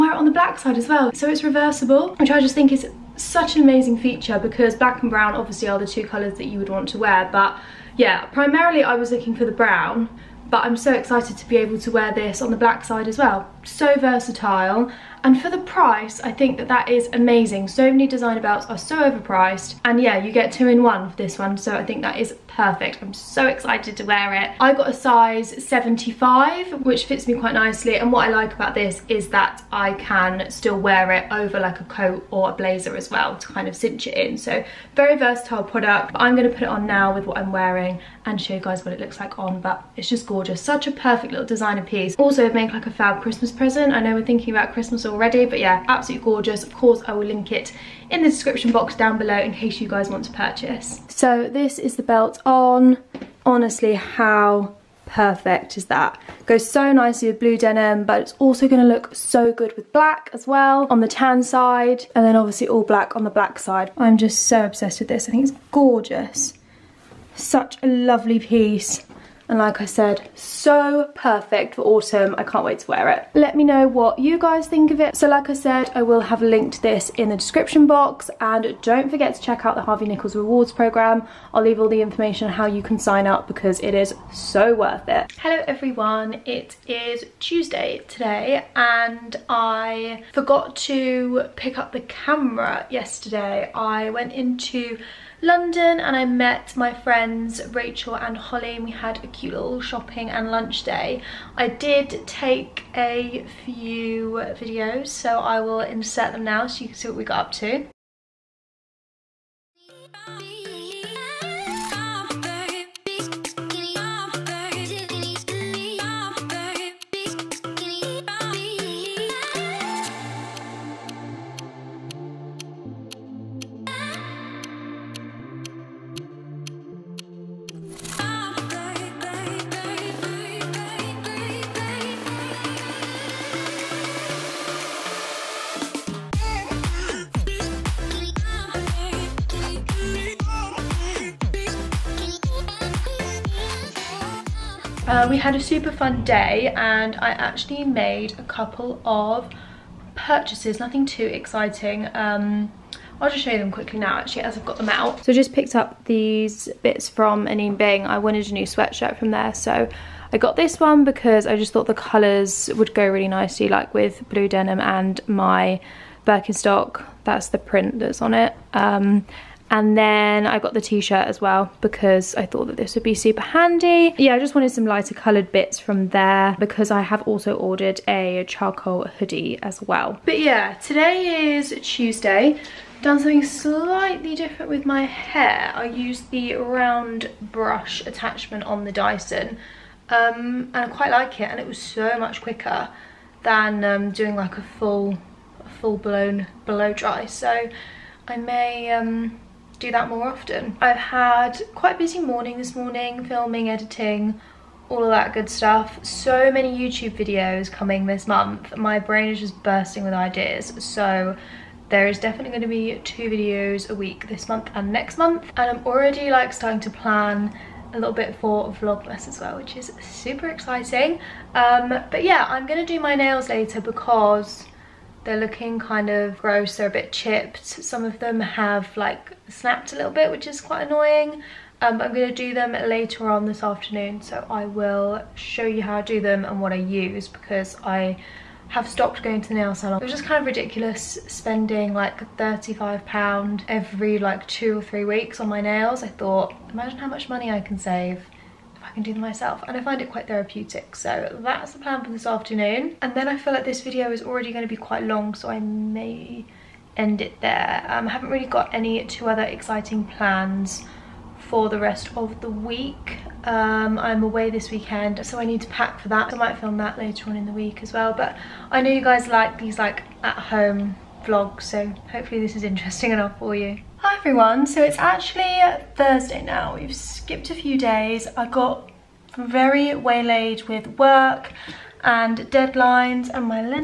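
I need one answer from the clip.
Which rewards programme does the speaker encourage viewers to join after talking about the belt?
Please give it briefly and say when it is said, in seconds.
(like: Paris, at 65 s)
Harvey Nichols Rewards Programme, at 79 s.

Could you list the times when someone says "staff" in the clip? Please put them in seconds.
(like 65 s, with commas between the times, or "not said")
not said.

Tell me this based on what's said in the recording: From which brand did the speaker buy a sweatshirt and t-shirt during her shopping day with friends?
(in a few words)
Anine Bing.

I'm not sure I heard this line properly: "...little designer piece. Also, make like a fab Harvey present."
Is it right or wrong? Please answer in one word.
wrong.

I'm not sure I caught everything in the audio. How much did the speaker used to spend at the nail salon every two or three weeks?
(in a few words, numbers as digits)
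£35.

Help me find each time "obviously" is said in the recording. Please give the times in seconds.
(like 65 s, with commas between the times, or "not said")
5 s, 62 s.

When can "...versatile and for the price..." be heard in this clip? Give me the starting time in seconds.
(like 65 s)
13 s.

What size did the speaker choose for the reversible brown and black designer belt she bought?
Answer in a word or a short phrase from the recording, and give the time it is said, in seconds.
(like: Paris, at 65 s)
75, at 24 s.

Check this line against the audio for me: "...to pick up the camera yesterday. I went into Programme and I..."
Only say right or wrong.
wrong.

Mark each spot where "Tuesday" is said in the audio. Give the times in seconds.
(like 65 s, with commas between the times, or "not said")
87 s, 181 s.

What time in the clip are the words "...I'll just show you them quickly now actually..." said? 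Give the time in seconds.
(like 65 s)
153 s.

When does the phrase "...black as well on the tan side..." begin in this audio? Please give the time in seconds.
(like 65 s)
59 s.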